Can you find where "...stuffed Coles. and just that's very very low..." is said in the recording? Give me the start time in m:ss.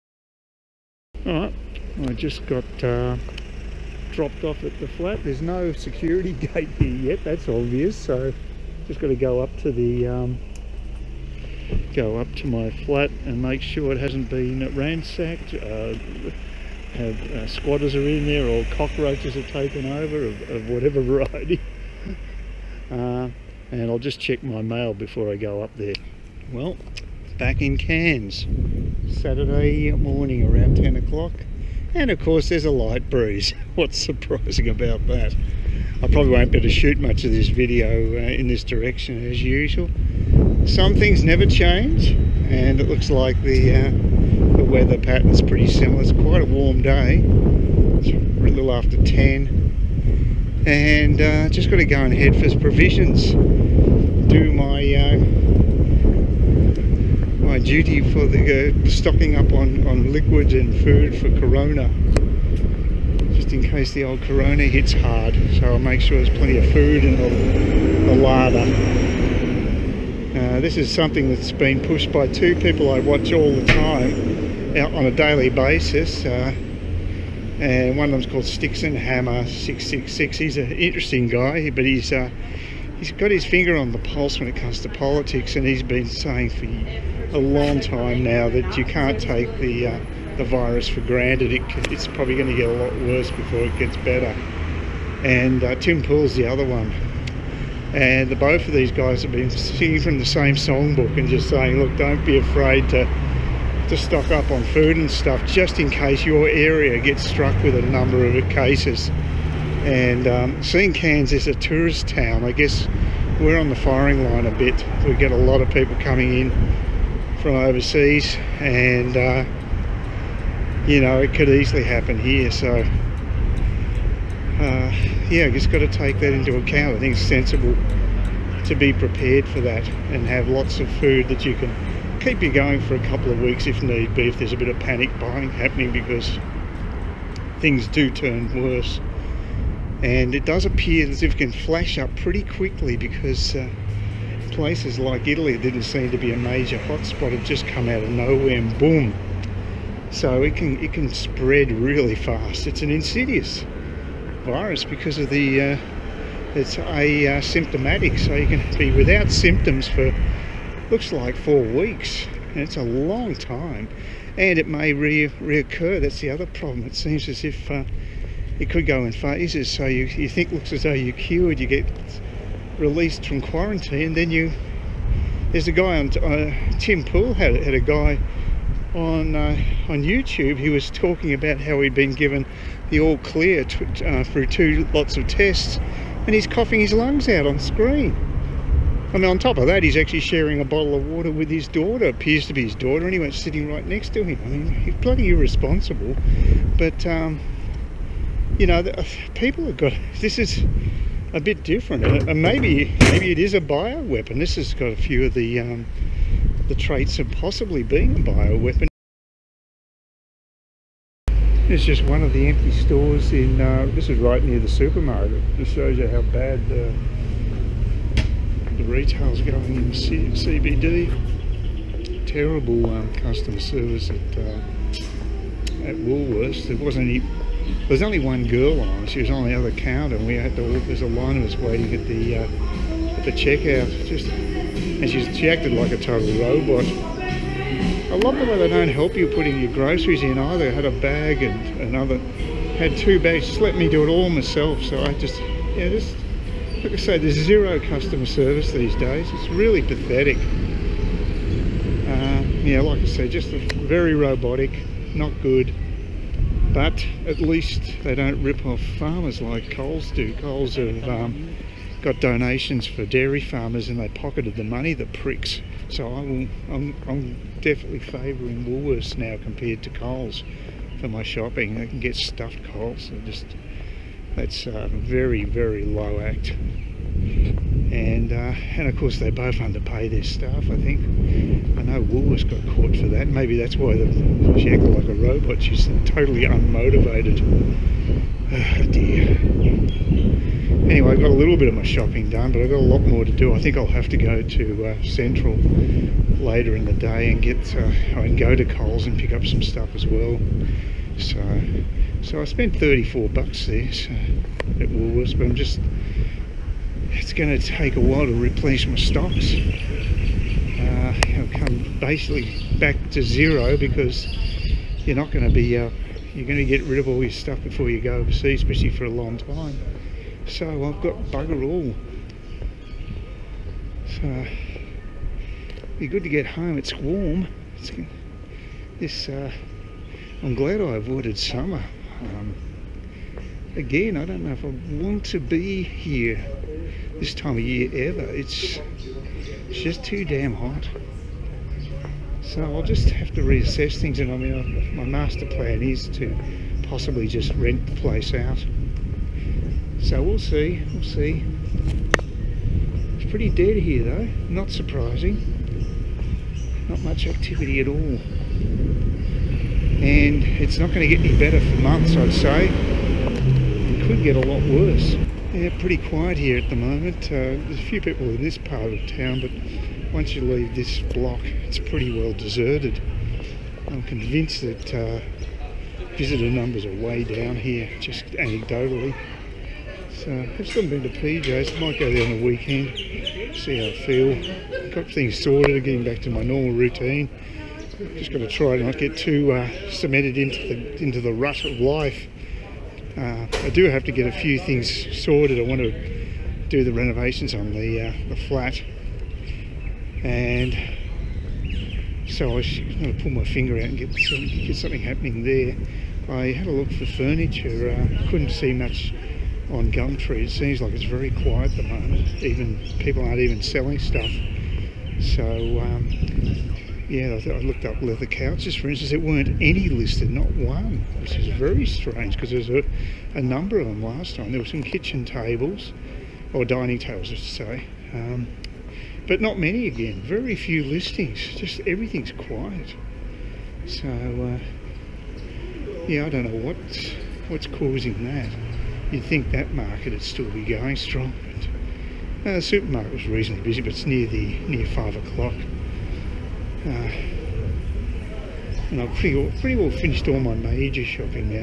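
4:32.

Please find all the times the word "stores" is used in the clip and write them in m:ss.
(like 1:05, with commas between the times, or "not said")
3:32.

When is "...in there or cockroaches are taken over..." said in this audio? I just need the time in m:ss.
0:18.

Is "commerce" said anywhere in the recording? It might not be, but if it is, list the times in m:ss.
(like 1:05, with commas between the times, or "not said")
not said.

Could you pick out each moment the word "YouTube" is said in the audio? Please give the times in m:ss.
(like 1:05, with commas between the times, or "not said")
3:00.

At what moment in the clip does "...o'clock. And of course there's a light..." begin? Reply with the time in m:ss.
0:30.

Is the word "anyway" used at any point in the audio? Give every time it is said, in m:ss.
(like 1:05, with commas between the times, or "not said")
3:13, 4:50.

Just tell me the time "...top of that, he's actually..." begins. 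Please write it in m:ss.
3:09.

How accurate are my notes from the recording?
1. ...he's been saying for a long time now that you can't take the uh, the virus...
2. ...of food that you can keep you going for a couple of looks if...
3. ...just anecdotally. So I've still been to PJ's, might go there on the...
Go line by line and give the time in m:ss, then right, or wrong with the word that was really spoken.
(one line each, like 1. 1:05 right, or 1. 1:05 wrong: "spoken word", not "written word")
1. 1:25 right
2. 2:10 wrong: "weeks", not "looks"
3. 6:17 right.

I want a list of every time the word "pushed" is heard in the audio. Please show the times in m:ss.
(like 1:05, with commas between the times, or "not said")
1:11.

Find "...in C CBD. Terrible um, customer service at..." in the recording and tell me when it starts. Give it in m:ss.
3:39.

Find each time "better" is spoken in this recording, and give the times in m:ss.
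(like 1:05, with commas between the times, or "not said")
1:33, 6:01.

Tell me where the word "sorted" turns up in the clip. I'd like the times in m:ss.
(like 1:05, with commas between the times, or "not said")
6:25, 6:35.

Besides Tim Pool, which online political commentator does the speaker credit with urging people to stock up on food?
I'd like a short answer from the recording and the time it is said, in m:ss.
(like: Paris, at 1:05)
Styxhexenhammer666, at 1:18.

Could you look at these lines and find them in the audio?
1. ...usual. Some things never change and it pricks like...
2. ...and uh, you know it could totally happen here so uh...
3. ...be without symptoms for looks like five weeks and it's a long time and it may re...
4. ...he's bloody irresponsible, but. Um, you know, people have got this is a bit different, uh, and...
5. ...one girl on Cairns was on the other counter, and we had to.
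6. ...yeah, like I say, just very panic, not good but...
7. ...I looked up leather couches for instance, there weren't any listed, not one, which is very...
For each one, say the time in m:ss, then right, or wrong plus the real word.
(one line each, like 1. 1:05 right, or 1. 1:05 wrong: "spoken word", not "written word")
1. 0:39 wrong: "looks", not "pricks"
2. 1:58 wrong: "easily", not "totally"
3. 2:38 wrong: "four", not "five"
4. 3:14 right
5. 3:48 wrong: "She", not "Cairns"
6. 4:12 wrong: "robotic", not "panic"
7. 6:57 right.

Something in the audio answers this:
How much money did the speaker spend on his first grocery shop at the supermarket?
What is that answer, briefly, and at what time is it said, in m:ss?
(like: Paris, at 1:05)
$34, at 5:02.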